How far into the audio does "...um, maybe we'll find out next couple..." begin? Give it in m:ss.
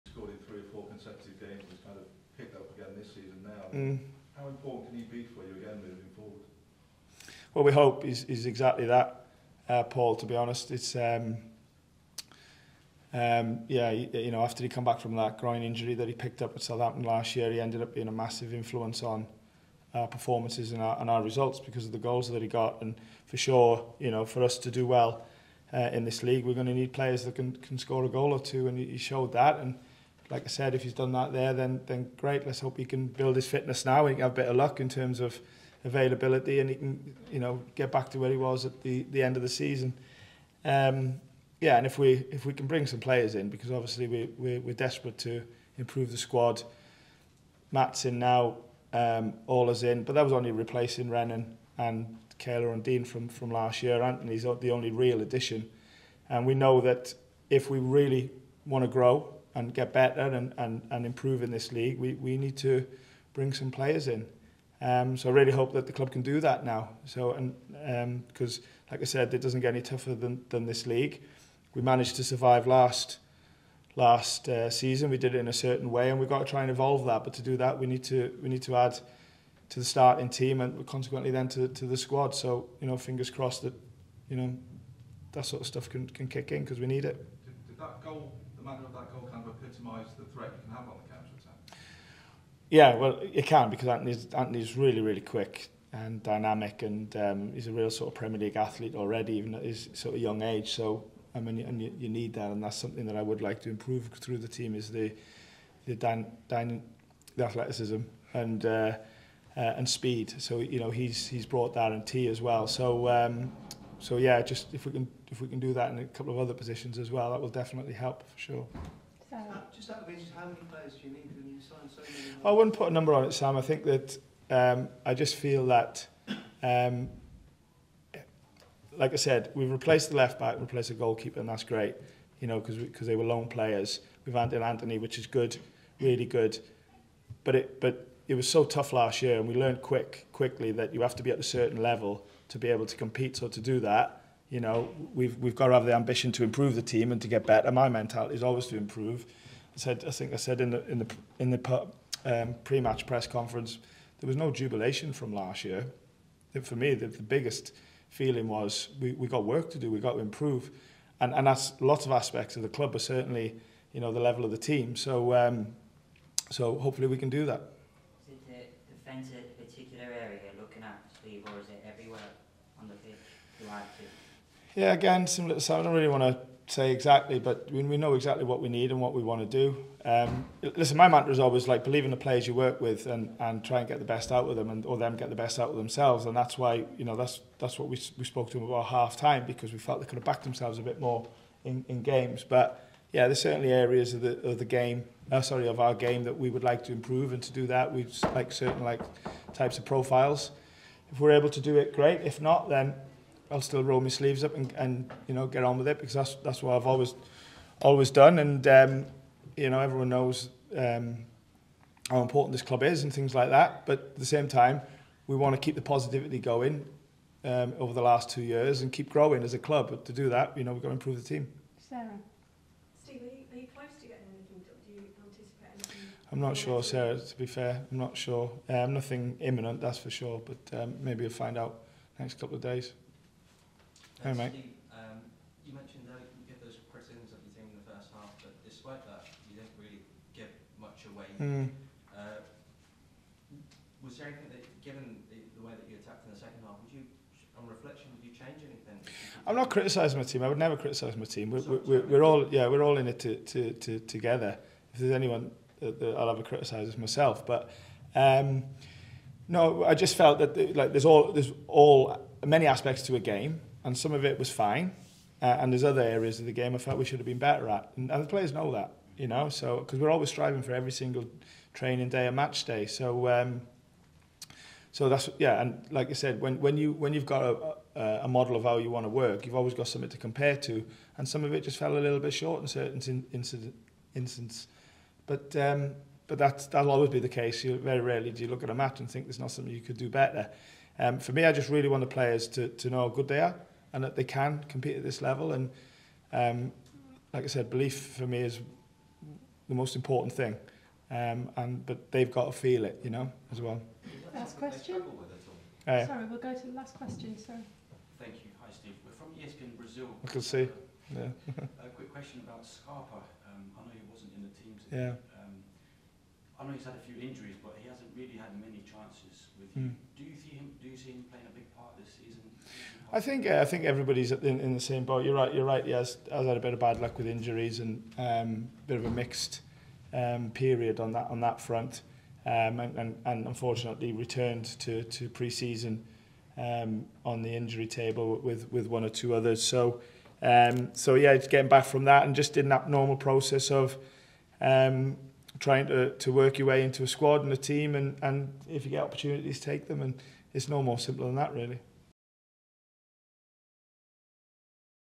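3:50.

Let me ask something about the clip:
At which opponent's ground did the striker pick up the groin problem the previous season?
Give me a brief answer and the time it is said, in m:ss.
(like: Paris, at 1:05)
Southampton, at 0:16.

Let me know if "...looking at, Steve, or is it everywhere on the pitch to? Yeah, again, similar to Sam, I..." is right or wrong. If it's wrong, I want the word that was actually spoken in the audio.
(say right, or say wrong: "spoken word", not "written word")
right.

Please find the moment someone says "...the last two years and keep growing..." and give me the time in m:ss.
3:37.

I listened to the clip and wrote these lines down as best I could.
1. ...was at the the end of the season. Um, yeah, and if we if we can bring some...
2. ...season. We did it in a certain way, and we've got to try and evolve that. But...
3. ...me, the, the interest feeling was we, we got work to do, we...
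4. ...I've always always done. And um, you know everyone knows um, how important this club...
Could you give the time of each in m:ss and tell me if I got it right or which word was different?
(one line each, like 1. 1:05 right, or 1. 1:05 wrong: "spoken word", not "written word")
1. 0:38 right
2. 1:14 right
3. 2:36 wrong: "biggest", not "interest"
4. 3:26 right.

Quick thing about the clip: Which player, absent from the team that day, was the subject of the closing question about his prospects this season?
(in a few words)
Scarpa.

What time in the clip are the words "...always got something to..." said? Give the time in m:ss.
4:39.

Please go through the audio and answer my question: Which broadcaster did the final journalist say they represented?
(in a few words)
ESPN Brazil.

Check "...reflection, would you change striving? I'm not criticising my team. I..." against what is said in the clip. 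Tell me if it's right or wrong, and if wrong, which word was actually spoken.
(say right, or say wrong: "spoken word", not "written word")
wrong: "anything", not "striving".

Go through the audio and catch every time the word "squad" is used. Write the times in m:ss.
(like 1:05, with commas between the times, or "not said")
0:46, 1:21, 5:47.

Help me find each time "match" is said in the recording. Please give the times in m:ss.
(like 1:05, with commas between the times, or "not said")
2:32, 4:32, 4:48.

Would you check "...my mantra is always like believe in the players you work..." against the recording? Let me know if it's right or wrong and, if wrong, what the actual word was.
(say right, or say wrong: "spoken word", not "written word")
right.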